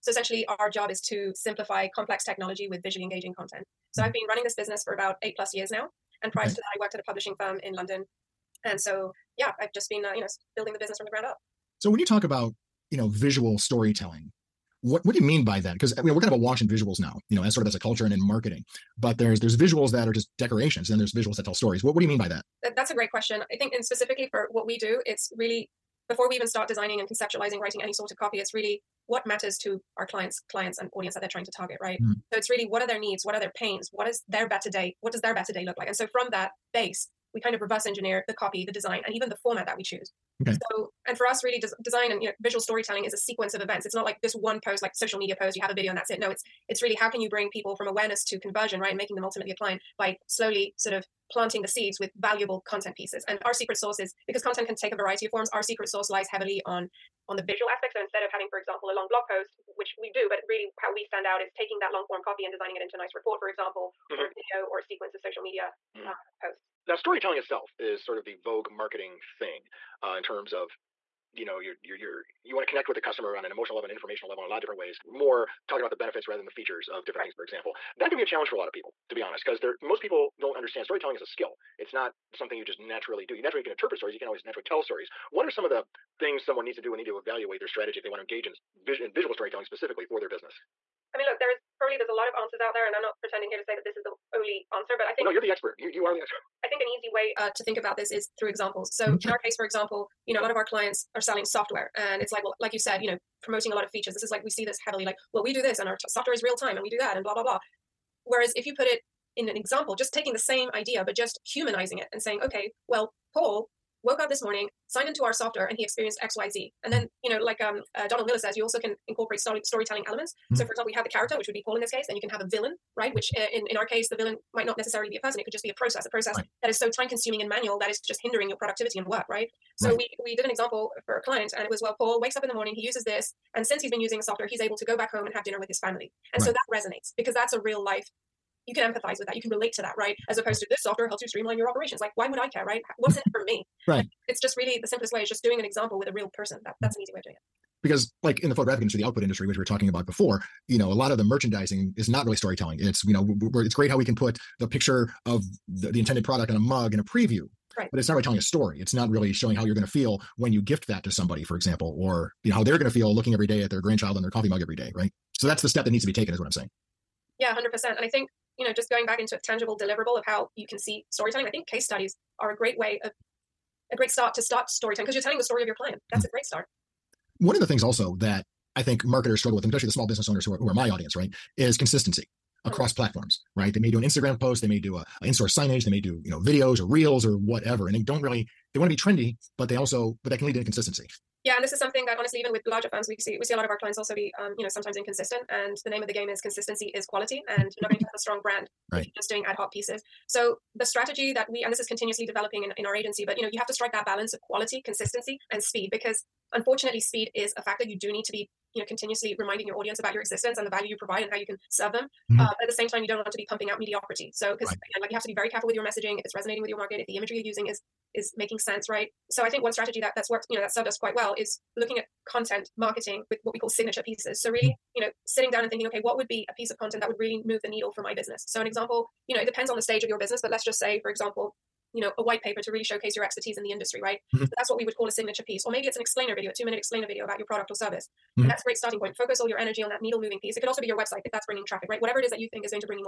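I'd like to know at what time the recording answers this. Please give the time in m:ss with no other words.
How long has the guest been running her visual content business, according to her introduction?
0:05.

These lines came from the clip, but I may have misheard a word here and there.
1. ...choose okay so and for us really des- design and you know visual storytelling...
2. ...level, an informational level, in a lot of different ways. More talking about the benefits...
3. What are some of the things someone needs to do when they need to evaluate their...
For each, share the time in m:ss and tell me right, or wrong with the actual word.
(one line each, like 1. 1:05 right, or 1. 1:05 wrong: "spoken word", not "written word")
1. 0:39 right
2. 1:13 right
3. 1:25 right.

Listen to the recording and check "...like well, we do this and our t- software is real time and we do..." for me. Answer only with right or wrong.
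right.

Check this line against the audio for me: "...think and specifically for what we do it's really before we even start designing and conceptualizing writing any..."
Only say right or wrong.
right.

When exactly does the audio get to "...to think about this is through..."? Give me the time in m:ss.
1:37.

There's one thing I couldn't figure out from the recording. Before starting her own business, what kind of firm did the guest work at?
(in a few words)
publishing firm.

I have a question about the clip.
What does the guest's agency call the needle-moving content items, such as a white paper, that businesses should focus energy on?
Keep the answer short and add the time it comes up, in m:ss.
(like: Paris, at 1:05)
signature pieces, at 3:43.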